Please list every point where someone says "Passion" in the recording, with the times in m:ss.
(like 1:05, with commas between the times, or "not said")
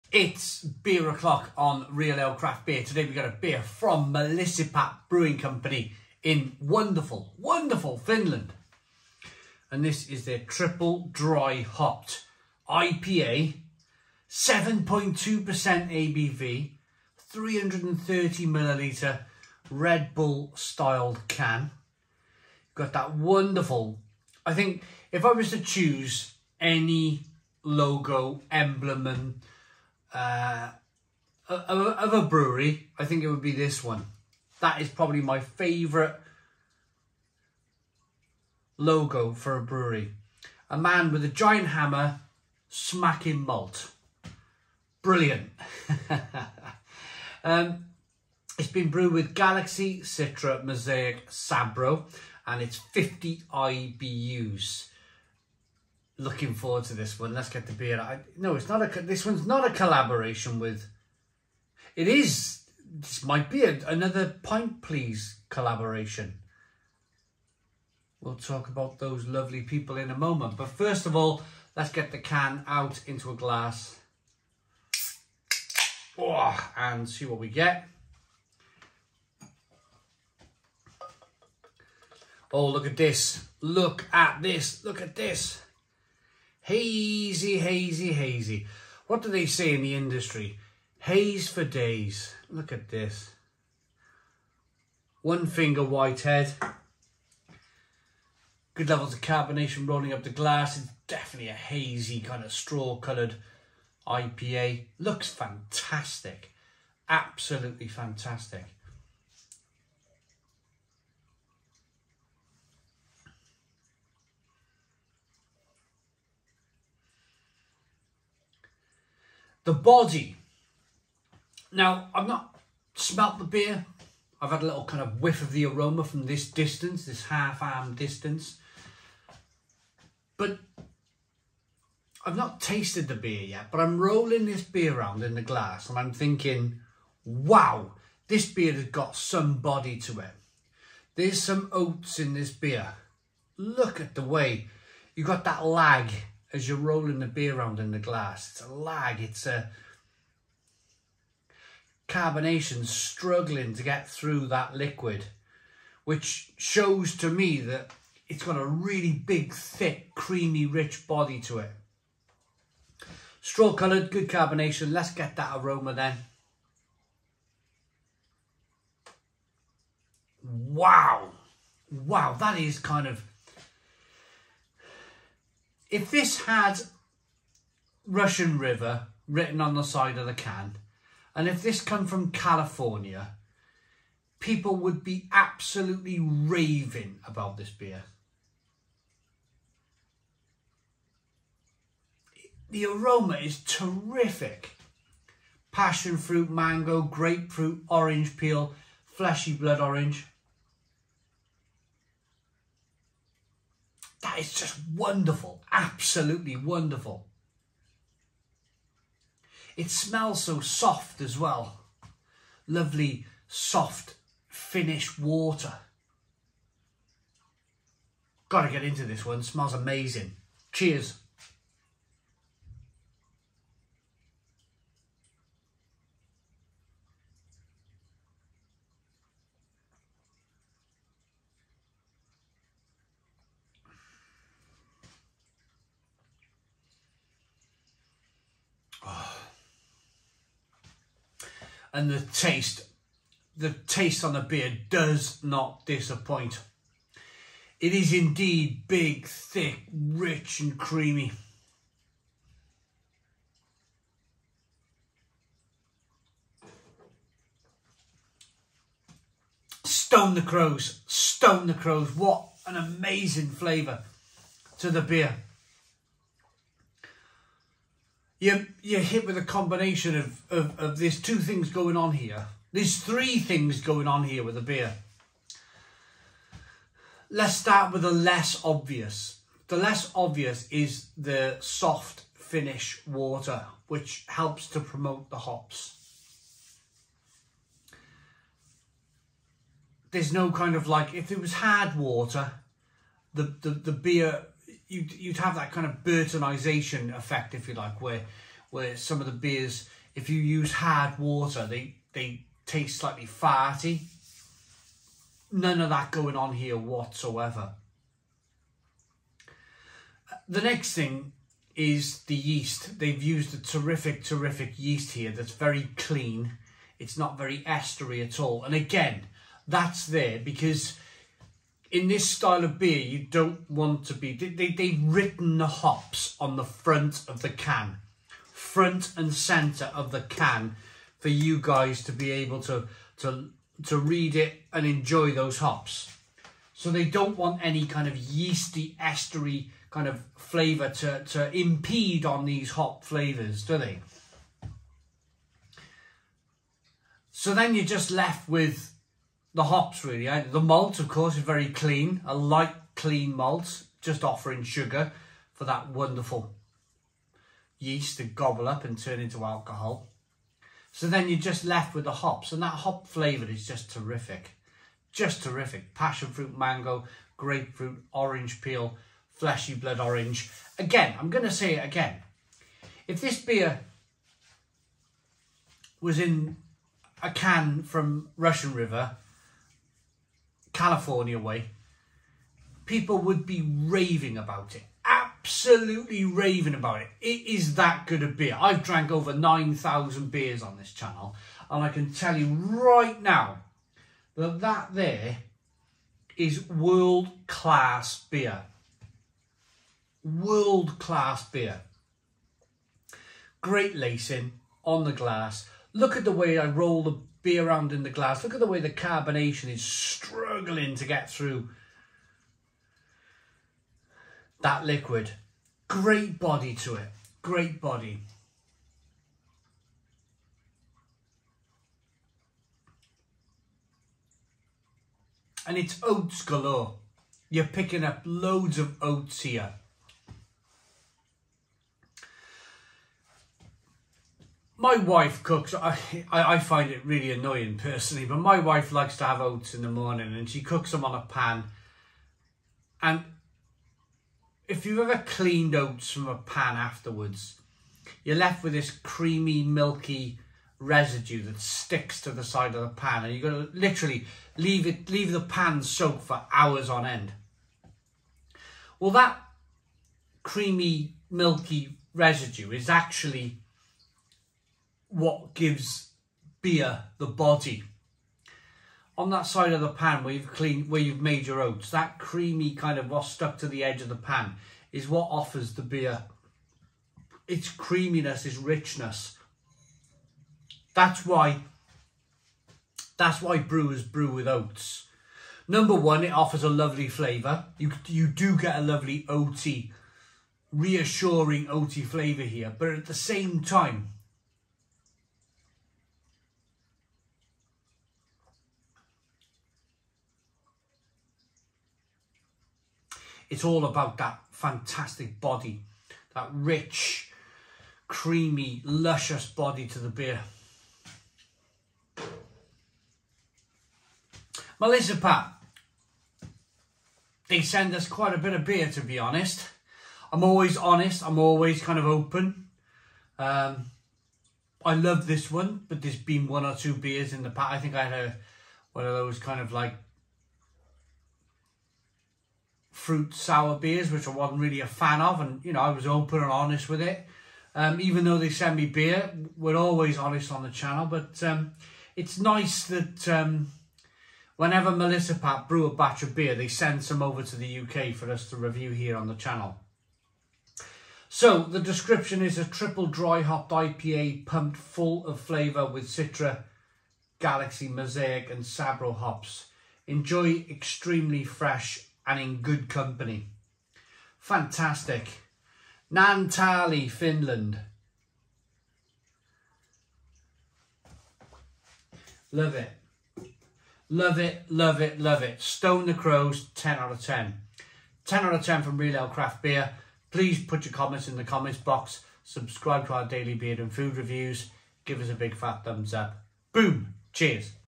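3:15, 6:05.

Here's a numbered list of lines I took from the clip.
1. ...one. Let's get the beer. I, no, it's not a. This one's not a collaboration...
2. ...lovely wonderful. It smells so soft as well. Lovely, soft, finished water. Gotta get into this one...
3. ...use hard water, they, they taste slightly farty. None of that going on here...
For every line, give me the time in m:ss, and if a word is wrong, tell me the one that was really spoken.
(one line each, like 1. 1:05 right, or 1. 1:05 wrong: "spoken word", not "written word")
1. 0:57 right
2. 3:25 wrong: "absolutely", not "lovely"
3. 5:00 right.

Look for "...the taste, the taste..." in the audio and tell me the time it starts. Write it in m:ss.
4:02.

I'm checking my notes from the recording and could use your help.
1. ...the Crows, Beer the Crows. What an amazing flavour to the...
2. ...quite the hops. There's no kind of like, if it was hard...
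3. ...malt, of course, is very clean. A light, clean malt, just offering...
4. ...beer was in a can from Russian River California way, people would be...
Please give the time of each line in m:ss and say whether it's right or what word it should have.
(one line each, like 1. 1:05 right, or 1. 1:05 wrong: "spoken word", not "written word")
1. 4:20 wrong: "Stone", not "Beer"
2. 4:44 wrong: "promote", not "quite"
3. 5:50 right
4. 6:13 right.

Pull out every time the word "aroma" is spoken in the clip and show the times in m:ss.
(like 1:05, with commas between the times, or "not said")
2:05, 2:45, 3:12.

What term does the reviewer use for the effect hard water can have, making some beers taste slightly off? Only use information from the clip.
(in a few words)
Burtonization.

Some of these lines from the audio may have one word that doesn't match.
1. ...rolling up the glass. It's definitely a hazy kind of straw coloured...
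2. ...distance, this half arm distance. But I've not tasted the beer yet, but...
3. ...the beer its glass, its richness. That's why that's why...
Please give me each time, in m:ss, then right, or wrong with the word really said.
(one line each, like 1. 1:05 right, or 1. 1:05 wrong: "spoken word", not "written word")
1. 1:39 right
2. 2:06 right
3. 7:55 wrong: "creaminess", not "glass".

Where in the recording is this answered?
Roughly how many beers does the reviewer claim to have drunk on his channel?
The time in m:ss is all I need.
6:29.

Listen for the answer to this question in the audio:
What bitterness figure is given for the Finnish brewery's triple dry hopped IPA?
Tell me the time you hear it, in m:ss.
0:52.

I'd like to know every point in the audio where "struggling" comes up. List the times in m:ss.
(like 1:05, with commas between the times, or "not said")
2:32, 6:49.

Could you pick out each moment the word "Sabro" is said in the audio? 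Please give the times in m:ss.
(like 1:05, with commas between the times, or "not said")
0:51, 9:18.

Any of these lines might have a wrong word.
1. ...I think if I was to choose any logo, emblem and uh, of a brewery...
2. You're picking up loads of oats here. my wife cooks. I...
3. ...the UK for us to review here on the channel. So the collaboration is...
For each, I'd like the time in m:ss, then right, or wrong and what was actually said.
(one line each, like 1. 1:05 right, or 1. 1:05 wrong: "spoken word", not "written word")
1. 0:24 right
2. 7:07 right
3. 9:07 wrong: "description", not "collaboration".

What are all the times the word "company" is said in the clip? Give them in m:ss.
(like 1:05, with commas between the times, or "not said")
0:05, 9:22.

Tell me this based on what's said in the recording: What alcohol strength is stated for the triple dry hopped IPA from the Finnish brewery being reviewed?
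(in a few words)
7.2%.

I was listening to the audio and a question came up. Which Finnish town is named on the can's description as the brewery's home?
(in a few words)
Naantali.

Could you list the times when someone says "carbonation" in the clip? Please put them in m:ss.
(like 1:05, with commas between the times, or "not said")
1:39, 2:32, 2:44, 6:48.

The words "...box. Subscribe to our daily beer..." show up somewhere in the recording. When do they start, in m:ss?
9:41.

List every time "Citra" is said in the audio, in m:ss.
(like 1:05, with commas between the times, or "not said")
0:50, 9:16.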